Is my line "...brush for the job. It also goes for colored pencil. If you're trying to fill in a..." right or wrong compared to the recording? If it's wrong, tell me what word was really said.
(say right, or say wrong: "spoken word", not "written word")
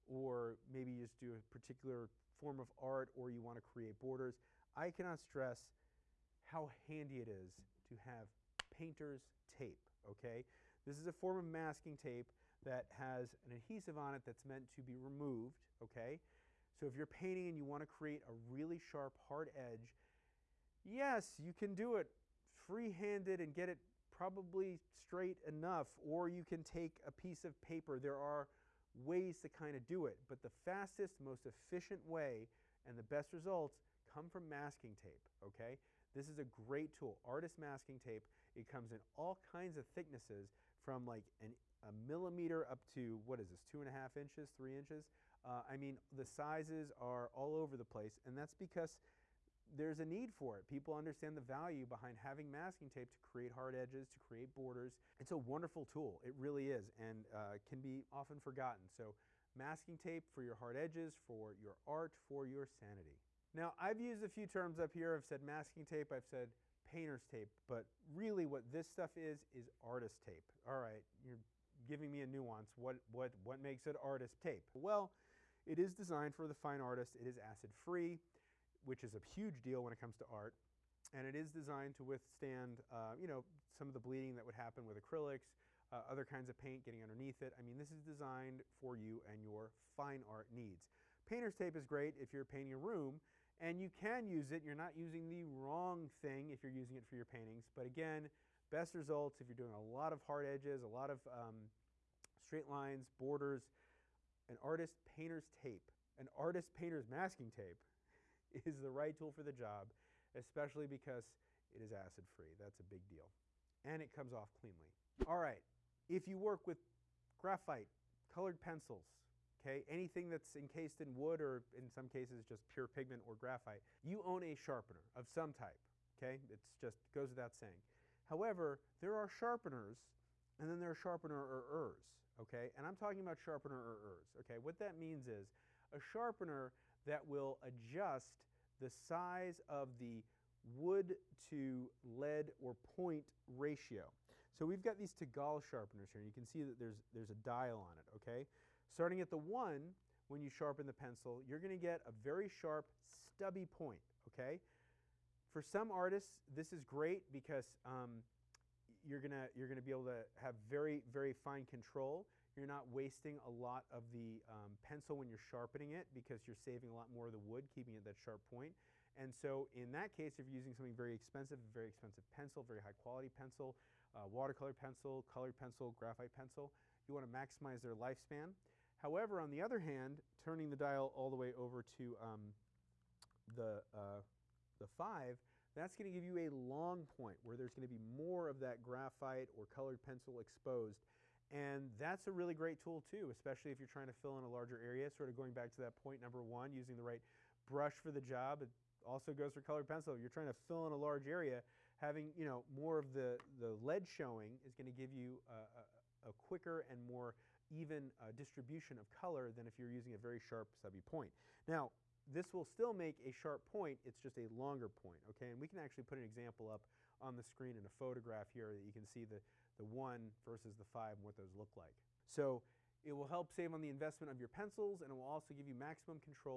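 right.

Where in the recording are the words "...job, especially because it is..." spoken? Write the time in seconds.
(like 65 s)
109 s.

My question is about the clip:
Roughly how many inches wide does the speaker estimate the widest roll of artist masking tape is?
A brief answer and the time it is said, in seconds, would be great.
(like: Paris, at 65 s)
3 inches, at 44 s.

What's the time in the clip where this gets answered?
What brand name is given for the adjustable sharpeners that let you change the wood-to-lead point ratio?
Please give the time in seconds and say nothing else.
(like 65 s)
145 s.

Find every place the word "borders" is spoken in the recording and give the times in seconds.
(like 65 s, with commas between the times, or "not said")
3 s, 54 s, 103 s.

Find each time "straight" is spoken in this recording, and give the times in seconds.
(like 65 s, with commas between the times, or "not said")
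24 s, 102 s.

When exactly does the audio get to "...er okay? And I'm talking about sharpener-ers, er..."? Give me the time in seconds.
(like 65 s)
132 s.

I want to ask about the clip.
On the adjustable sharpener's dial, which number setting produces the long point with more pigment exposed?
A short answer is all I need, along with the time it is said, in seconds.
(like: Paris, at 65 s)
5, at 184 s.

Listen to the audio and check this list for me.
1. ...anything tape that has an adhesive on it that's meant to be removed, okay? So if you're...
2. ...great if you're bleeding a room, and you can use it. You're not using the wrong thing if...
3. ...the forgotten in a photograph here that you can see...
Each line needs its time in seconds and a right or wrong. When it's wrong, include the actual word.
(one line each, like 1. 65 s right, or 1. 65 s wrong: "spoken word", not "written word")
1. 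11 s wrong: "masking", not "anything"
2. 91 s wrong: "painting", not "bleeding"
3. 217 s wrong: "screen", not "forgotten".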